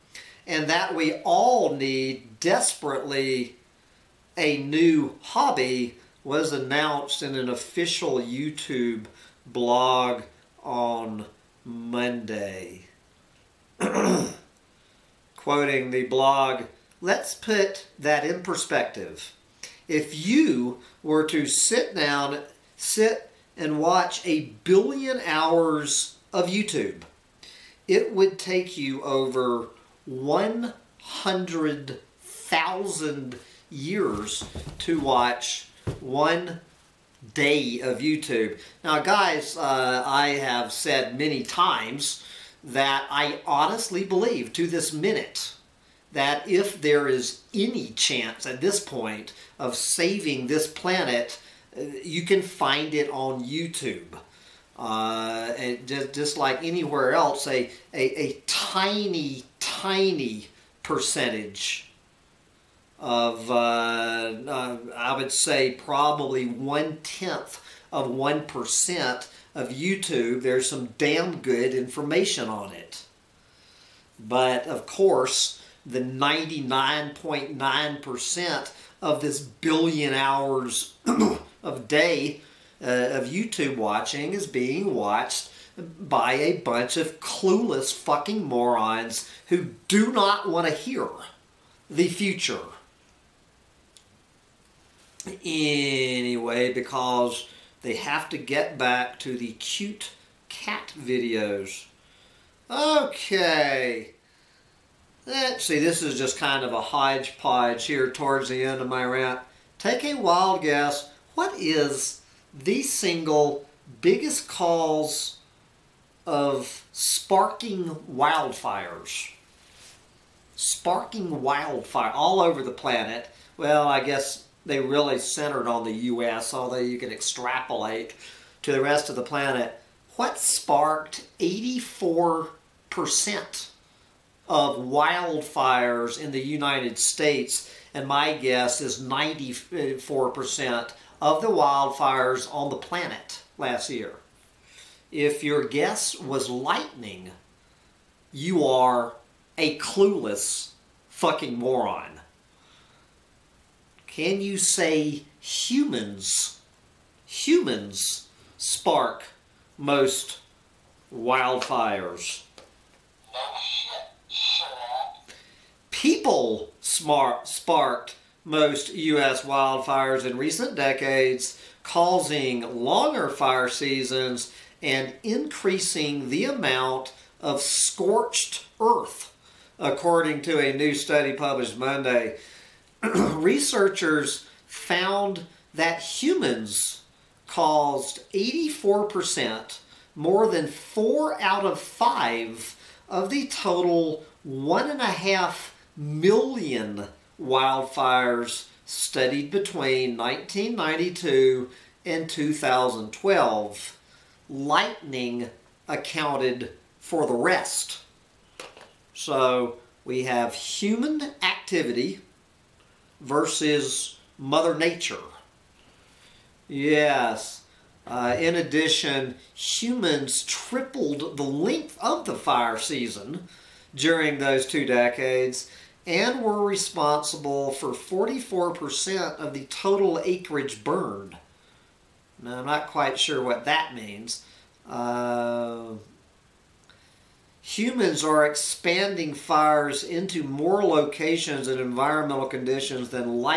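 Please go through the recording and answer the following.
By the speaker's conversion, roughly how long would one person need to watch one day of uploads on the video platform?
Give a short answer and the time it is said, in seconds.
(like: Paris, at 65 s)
100,000 years, at 30 s.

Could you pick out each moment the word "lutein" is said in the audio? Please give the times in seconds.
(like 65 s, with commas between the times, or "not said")
not said.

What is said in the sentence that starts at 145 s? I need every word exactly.
If your guess was lightning, you are a clueless fucking moron.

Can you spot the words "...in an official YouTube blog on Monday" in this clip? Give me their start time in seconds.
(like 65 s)
7 s.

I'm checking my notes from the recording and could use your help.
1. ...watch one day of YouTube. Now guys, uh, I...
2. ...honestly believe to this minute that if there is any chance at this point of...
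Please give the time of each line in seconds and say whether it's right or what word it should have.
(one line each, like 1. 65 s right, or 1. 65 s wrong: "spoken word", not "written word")
1. 34 s right
2. 43 s right.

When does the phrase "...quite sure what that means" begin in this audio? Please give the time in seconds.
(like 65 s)
232 s.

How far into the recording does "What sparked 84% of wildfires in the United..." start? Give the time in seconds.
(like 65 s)
130 s.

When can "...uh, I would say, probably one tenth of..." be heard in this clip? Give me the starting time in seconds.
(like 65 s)
64 s.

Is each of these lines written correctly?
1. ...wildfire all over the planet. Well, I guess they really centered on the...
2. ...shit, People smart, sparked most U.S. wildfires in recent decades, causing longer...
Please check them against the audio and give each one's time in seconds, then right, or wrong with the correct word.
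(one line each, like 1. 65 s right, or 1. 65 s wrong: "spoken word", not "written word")
1. 121 s right
2. 164 s right.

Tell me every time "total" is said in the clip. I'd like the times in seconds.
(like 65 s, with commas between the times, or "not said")
193 s, 229 s.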